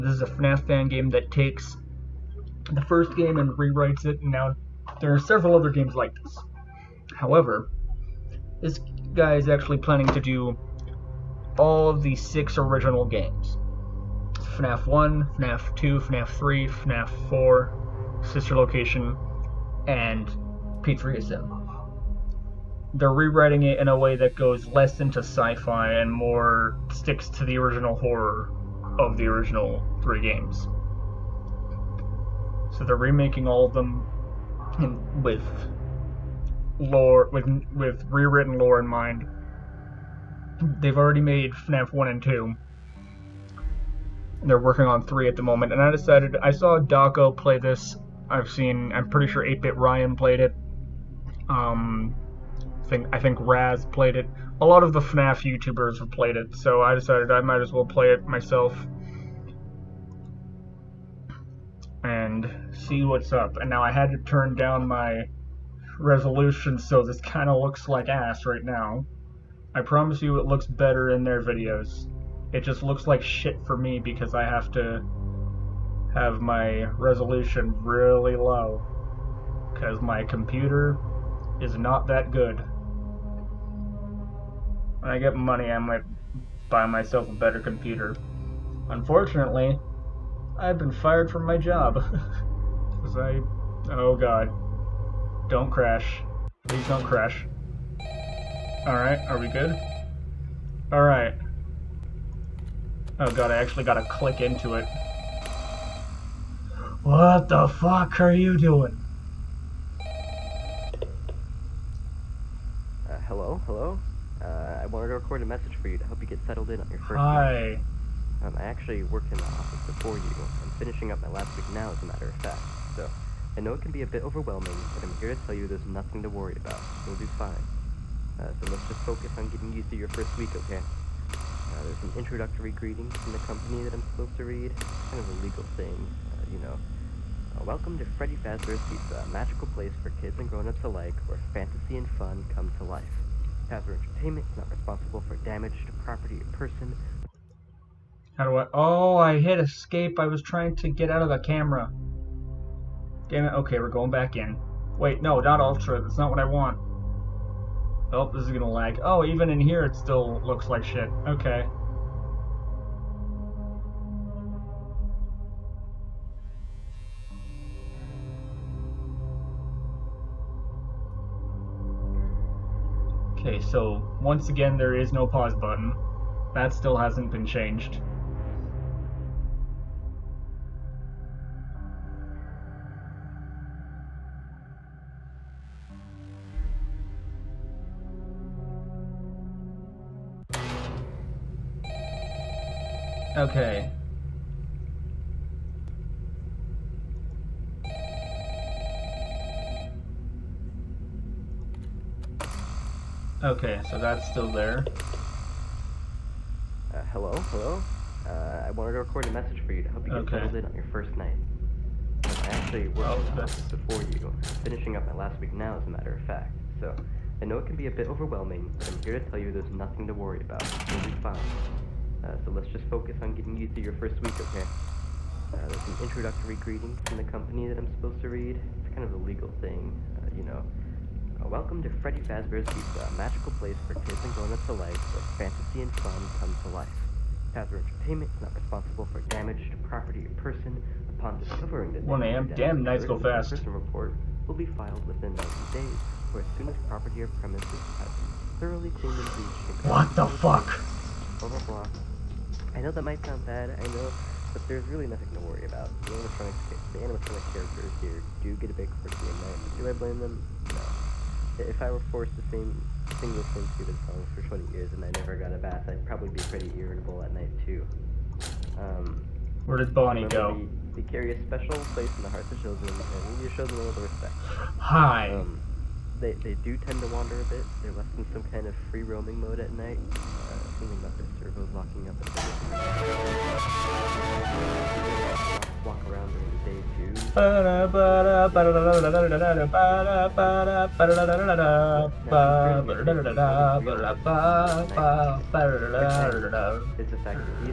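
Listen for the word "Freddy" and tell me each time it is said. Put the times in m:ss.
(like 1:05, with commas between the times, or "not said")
2:18, 3:52.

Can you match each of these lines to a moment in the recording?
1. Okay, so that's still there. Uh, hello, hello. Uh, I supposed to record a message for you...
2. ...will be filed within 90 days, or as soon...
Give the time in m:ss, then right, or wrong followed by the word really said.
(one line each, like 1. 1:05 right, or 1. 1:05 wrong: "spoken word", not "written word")
1. 3:23 wrong: "wanted", not "supposed"
2. 4:04 right.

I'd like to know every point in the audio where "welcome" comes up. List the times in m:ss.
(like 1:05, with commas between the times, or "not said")
2:17, 3:51.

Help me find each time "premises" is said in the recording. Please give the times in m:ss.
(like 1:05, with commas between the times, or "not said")
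4:07.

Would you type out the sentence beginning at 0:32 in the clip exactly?
So they're remaking all of them in, with lore, with, with rewritten lore in mind.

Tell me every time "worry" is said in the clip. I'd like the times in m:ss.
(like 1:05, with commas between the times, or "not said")
2:06, 3:40, 4:15.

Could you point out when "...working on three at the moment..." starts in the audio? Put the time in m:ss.
0:44.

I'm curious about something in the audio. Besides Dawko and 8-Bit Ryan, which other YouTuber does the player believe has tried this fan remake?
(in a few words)
Raz.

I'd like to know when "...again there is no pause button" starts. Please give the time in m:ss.
2:54.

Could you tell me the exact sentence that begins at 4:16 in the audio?
The animatronic, the animatronic characters here do get a bit quirky and night, do I blame them?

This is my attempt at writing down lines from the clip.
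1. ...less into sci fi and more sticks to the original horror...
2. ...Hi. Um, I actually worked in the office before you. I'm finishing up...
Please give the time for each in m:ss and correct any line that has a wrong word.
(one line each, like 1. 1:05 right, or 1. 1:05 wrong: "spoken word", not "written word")
1. 0:24 right
2. 1:57 right.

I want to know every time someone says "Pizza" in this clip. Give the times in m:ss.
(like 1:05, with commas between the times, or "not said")
2:18, 3:52.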